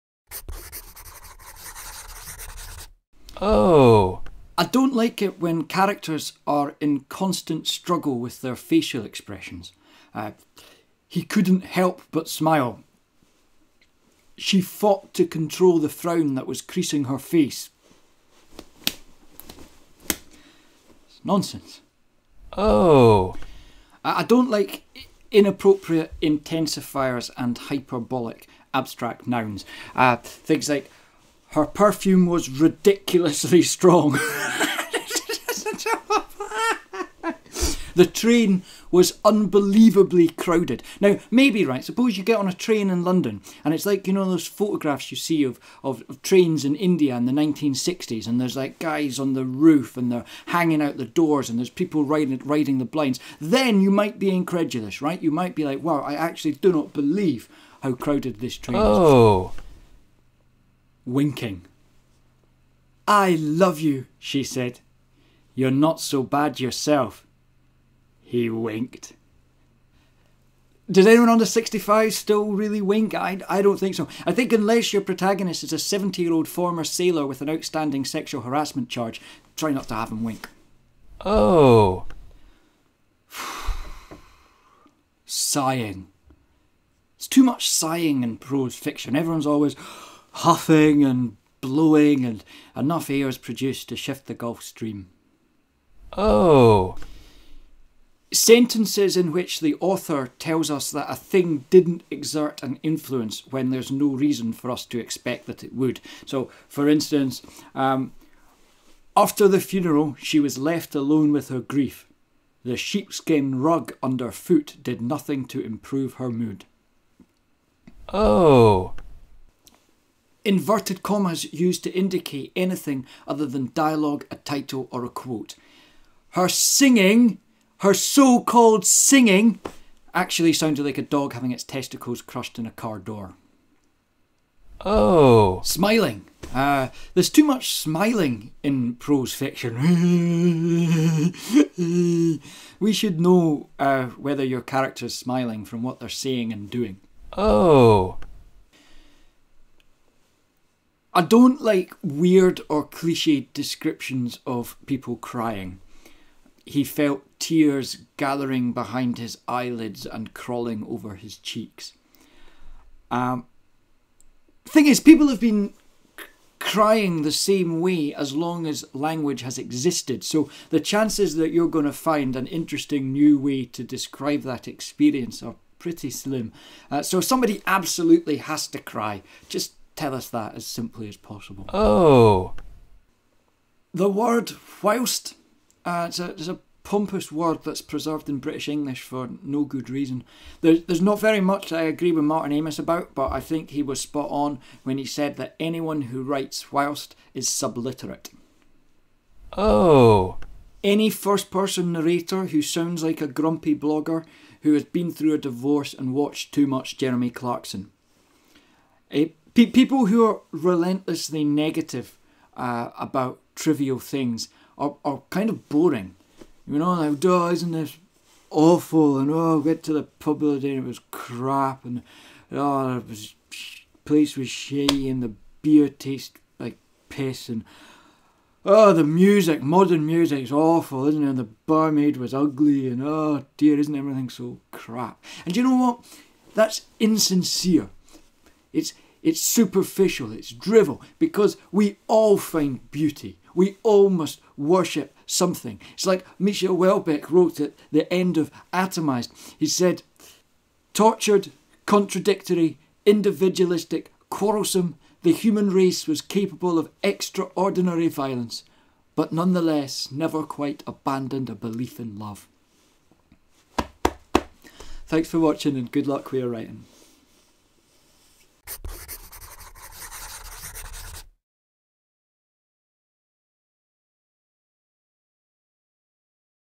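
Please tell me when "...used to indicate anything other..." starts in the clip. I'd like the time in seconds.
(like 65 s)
121 s.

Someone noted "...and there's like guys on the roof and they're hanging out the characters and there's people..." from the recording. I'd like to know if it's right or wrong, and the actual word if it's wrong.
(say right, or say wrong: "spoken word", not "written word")
wrong: "doors", not "characters".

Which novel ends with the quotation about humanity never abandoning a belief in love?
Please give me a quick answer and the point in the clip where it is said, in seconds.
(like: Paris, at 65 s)
Atomized, at 248 s.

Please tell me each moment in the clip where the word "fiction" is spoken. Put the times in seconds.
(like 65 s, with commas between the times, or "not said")
88 s, 139 s.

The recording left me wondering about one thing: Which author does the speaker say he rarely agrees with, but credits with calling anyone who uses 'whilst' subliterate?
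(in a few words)
Martin Amis.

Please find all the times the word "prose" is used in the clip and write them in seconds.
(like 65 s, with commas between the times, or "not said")
88 s, 138 s.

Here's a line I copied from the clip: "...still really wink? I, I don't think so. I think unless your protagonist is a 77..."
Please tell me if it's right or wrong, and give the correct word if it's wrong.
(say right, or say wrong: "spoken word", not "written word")
wrong: "70", not "77".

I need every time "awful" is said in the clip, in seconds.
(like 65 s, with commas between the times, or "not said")
218 s, 230 s.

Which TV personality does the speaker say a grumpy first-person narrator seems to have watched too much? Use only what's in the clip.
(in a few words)
Jeremy Clarkson.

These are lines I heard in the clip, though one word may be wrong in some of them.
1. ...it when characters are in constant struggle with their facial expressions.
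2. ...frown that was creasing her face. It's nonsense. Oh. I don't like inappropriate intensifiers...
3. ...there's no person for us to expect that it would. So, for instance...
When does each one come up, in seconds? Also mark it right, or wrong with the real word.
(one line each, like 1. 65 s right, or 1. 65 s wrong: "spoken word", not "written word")
1. 5 s right
2. 15 s right
3. 103 s wrong: "reason", not "person".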